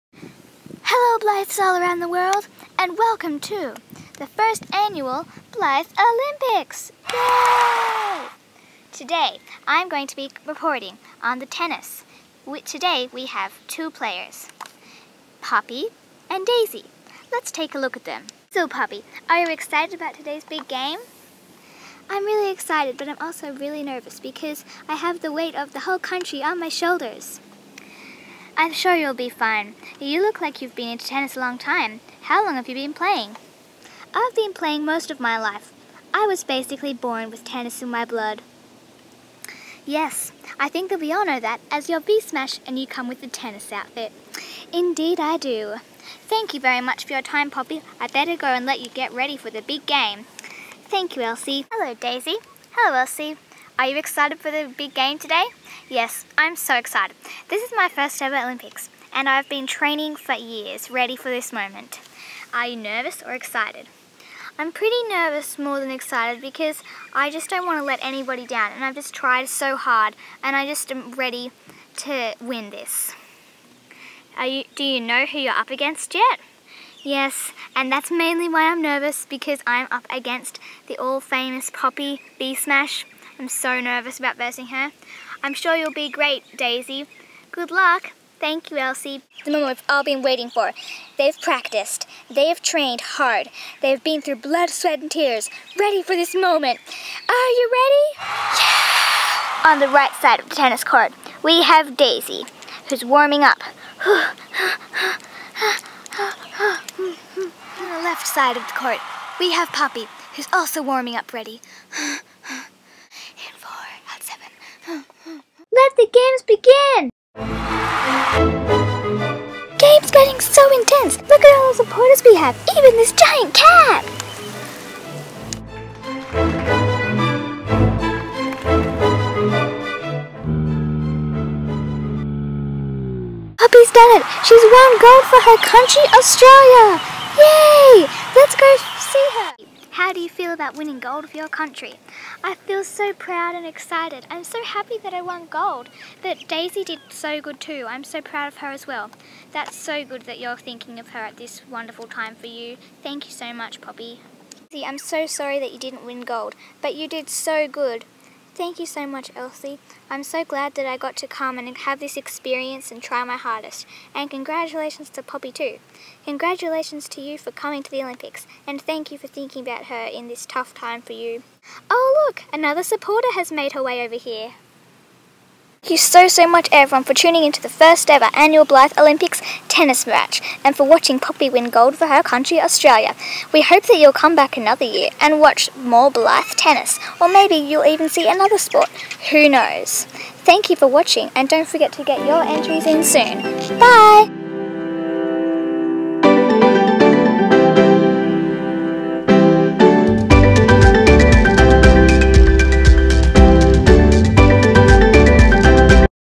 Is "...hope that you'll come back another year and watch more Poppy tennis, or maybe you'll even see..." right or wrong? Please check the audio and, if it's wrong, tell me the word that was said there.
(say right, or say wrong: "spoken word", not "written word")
wrong: "Blythe", not "Poppy".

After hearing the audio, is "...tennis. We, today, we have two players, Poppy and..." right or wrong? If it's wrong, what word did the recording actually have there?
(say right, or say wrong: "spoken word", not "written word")
right.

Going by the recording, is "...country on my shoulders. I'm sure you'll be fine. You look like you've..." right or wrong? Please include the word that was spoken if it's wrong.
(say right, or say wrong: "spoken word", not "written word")
right.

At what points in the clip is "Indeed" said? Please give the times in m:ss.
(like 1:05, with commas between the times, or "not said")
0:44.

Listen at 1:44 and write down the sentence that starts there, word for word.
On the left side of the court, we have Poppy, who's also warming up ready.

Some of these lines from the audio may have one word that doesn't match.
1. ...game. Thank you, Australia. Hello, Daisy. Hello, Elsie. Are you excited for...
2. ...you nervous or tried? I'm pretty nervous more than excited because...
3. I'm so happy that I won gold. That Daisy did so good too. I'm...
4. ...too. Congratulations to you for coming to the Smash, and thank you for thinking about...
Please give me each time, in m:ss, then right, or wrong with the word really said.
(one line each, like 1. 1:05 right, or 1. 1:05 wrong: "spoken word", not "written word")
1. 0:49 wrong: "Elsie", not "Australia"
2. 1:02 wrong: "excited", not "tried"
3. 2:24 right
4. 2:45 wrong: "Olympics", not "Smash".